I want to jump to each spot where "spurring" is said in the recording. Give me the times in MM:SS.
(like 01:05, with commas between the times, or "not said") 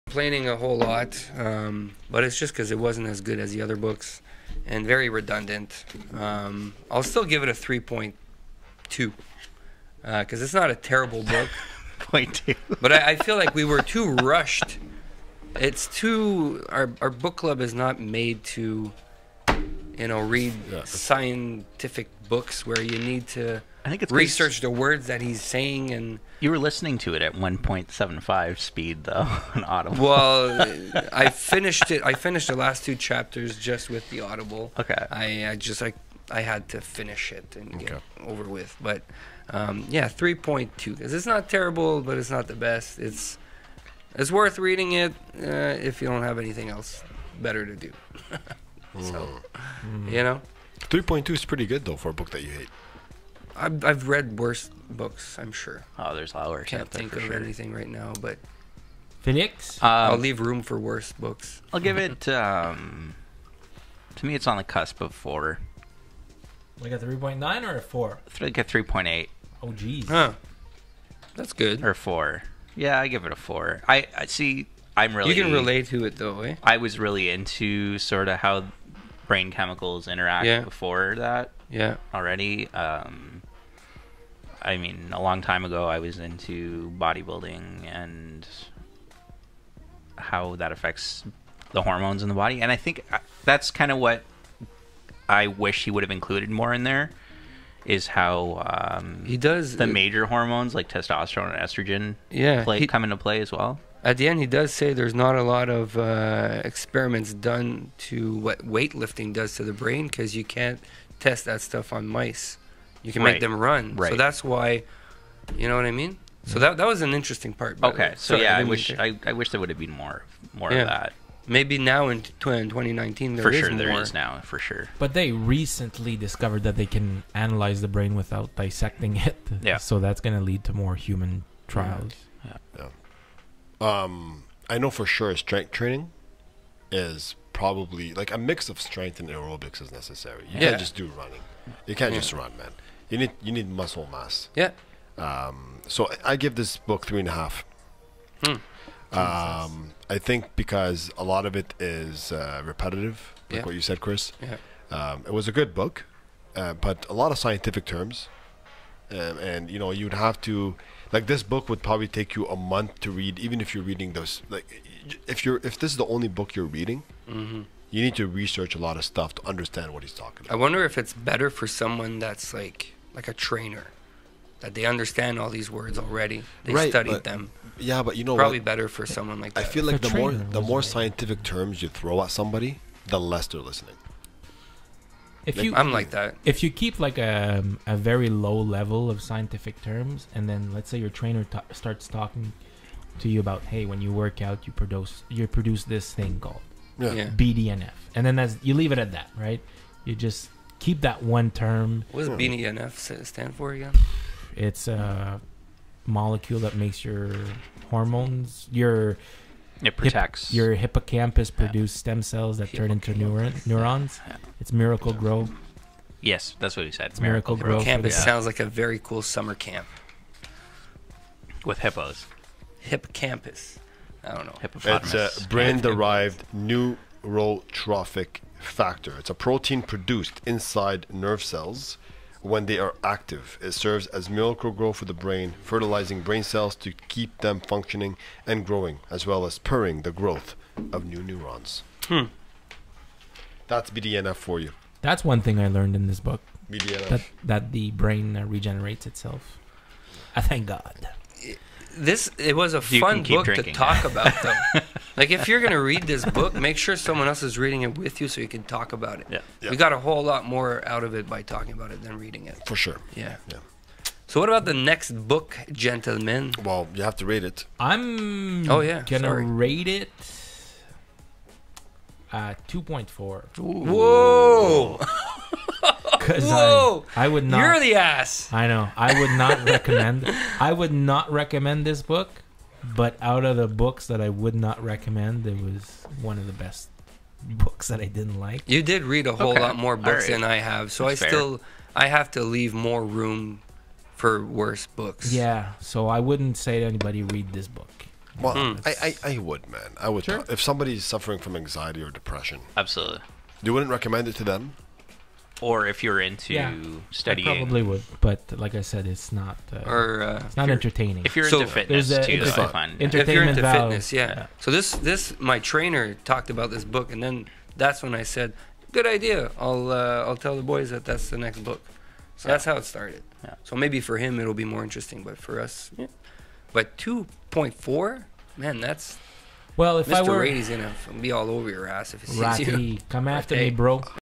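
03:59.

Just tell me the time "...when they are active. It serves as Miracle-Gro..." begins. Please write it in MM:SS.
03:52.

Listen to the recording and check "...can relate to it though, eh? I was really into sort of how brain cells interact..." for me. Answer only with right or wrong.
wrong.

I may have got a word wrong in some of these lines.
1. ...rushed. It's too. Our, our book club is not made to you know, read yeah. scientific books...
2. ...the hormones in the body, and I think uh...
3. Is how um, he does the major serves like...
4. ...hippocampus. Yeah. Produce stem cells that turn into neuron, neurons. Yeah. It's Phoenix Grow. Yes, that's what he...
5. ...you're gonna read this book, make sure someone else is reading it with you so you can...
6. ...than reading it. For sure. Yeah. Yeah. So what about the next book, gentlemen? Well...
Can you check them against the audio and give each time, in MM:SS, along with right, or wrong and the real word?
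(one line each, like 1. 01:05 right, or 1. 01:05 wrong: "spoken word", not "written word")
1. 00:14 right
2. 01:31 right
3. 01:37 wrong: "hormones", not "serves"
4. 03:30 wrong: "Miracle", not "Phoenix"
5. 04:15 right
6. 04:22 right.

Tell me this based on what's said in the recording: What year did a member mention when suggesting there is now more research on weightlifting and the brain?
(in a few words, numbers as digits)
2019.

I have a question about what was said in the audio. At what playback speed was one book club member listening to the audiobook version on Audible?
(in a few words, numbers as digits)
1.75.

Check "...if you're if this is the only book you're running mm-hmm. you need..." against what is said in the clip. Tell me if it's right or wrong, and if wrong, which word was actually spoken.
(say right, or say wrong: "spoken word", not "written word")
wrong: "reading", not "running".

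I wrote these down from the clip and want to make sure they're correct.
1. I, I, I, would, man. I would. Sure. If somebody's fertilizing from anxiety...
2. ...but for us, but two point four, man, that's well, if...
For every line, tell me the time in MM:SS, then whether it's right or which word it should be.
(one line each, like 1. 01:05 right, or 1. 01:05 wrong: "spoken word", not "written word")
1. 04:58 wrong: "suffering", not "fertilizing"
2. 05:25 right.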